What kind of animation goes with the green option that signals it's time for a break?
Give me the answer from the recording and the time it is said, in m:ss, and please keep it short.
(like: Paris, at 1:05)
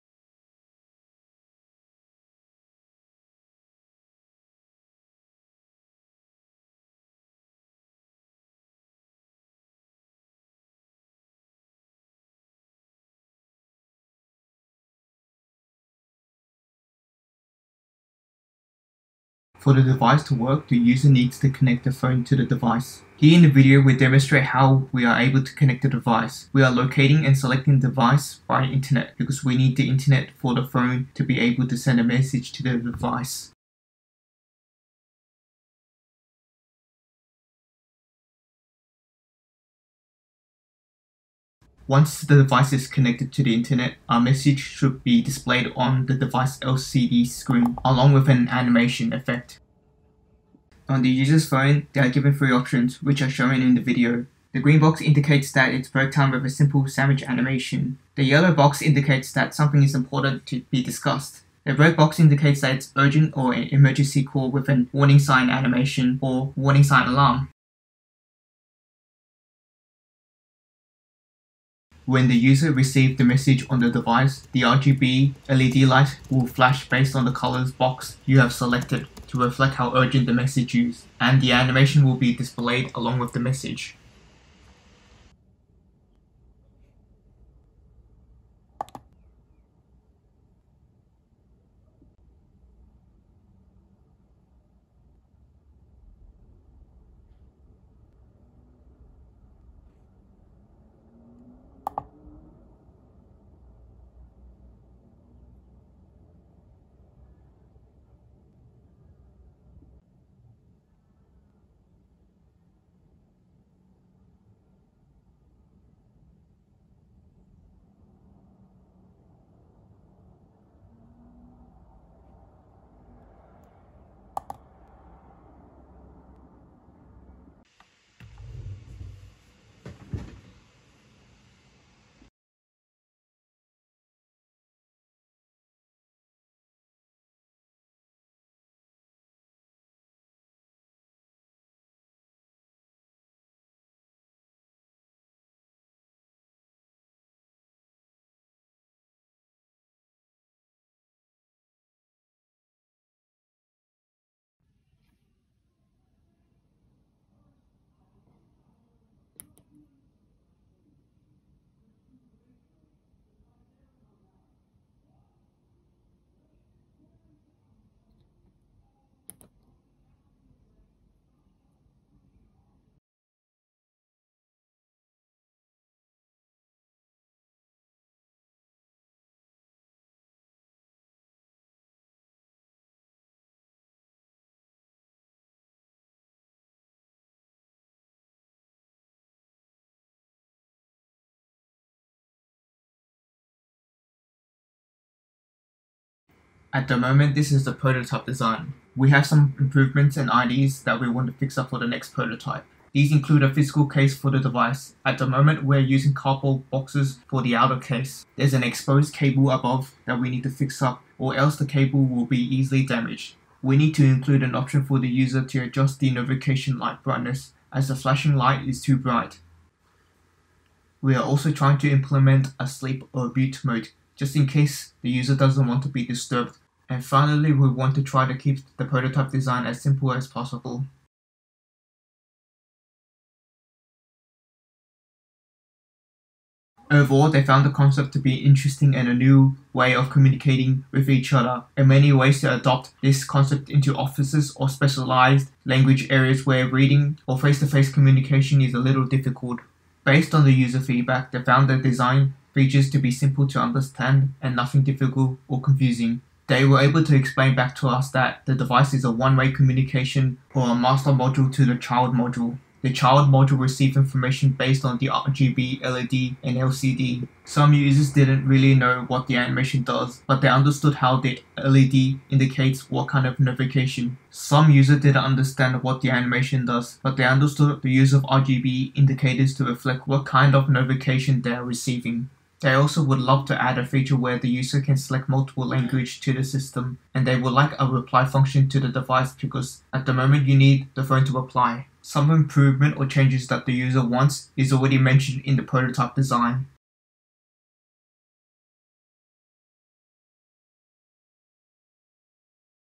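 Sandwich animation, at 0:56.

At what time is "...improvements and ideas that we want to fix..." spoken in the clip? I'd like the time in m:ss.
3:19.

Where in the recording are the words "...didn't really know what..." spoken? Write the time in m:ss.
4:28.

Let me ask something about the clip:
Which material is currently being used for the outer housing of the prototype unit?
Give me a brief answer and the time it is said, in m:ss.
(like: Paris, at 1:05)
Cardboard boxes, at 3:26.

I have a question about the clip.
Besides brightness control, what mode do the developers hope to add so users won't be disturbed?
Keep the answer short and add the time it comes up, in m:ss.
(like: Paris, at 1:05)
Sleep or mute mode, at 3:42.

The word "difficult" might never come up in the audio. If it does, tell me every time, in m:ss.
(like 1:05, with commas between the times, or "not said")
4:09, 4:14.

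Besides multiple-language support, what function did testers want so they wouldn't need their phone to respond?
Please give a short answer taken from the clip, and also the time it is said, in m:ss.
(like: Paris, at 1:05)
Reply function, at 4:47.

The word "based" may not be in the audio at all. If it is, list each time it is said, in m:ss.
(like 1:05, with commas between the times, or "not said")
1:16, 4:10, 4:24.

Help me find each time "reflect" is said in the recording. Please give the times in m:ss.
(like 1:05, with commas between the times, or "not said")
1:19, 4:39.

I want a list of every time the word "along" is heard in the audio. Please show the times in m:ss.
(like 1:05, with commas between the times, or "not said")
0:47, 1:22.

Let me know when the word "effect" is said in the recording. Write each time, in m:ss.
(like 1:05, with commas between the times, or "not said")
0:49.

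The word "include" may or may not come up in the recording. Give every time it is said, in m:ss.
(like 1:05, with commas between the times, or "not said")
3:23, 3:34.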